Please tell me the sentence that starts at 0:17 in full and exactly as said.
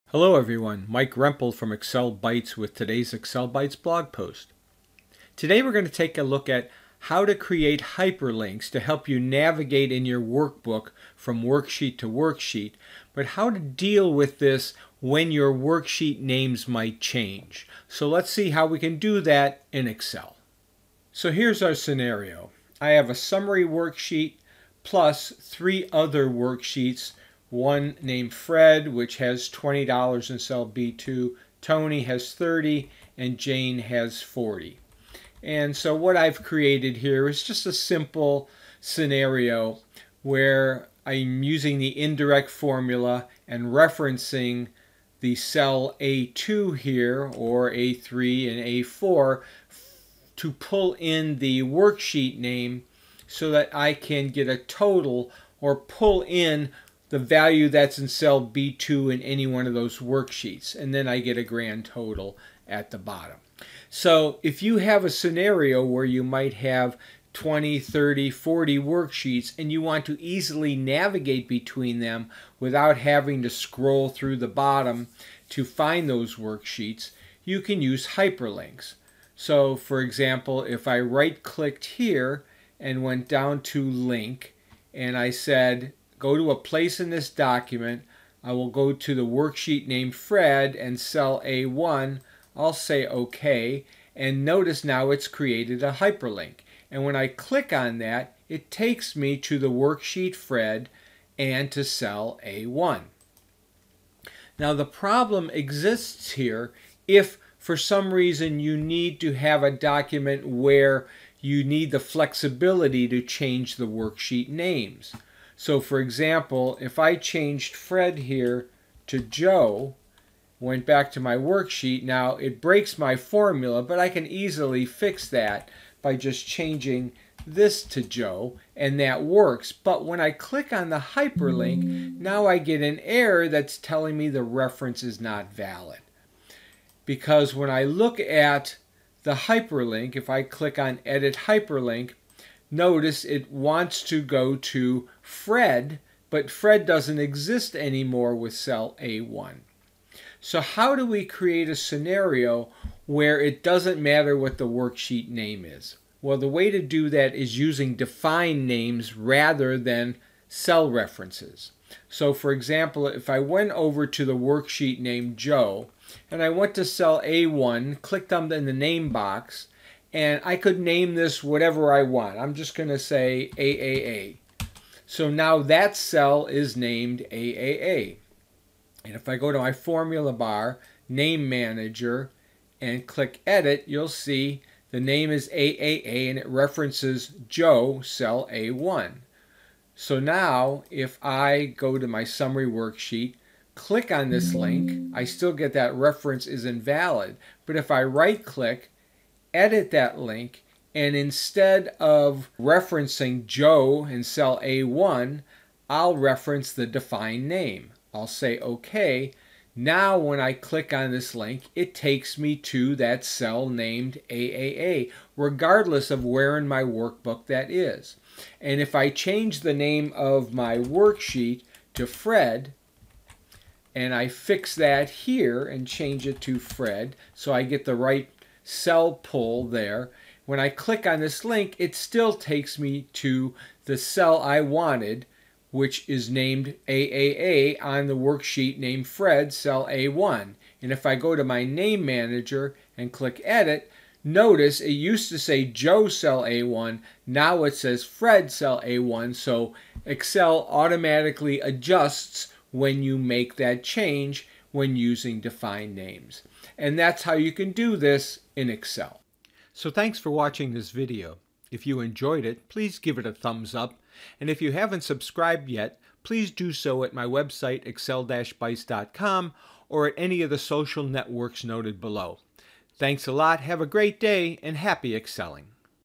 So let's see how we can do that in Excel.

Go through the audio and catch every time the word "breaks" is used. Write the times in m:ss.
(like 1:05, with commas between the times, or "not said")
2:02.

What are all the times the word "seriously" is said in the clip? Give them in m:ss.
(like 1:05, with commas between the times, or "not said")
not said.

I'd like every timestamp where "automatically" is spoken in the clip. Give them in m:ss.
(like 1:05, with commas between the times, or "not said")
4:10.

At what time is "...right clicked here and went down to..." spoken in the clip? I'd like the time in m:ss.
1:21.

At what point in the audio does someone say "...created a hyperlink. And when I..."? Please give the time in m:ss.
1:35.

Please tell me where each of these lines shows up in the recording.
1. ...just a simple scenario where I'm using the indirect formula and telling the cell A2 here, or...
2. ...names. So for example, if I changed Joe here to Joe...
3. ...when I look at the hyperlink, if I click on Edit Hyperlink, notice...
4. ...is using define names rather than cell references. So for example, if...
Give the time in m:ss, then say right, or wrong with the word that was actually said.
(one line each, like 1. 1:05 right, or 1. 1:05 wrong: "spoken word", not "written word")
1. 0:37 wrong: "referencing", not "telling"
2. 1:54 wrong: "Fred", not "Joe"
3. 2:17 right
4. 2:37 right.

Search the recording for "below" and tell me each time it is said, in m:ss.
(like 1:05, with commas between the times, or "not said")
4:31.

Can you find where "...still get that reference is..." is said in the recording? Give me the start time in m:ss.
3:15.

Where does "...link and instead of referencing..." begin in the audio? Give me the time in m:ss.
3:20.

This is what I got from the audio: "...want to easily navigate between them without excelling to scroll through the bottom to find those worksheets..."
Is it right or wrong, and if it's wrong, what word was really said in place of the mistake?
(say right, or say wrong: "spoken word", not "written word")
wrong: "having", not "excelling".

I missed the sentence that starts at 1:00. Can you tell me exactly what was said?
And then I get a grand total at the bottom.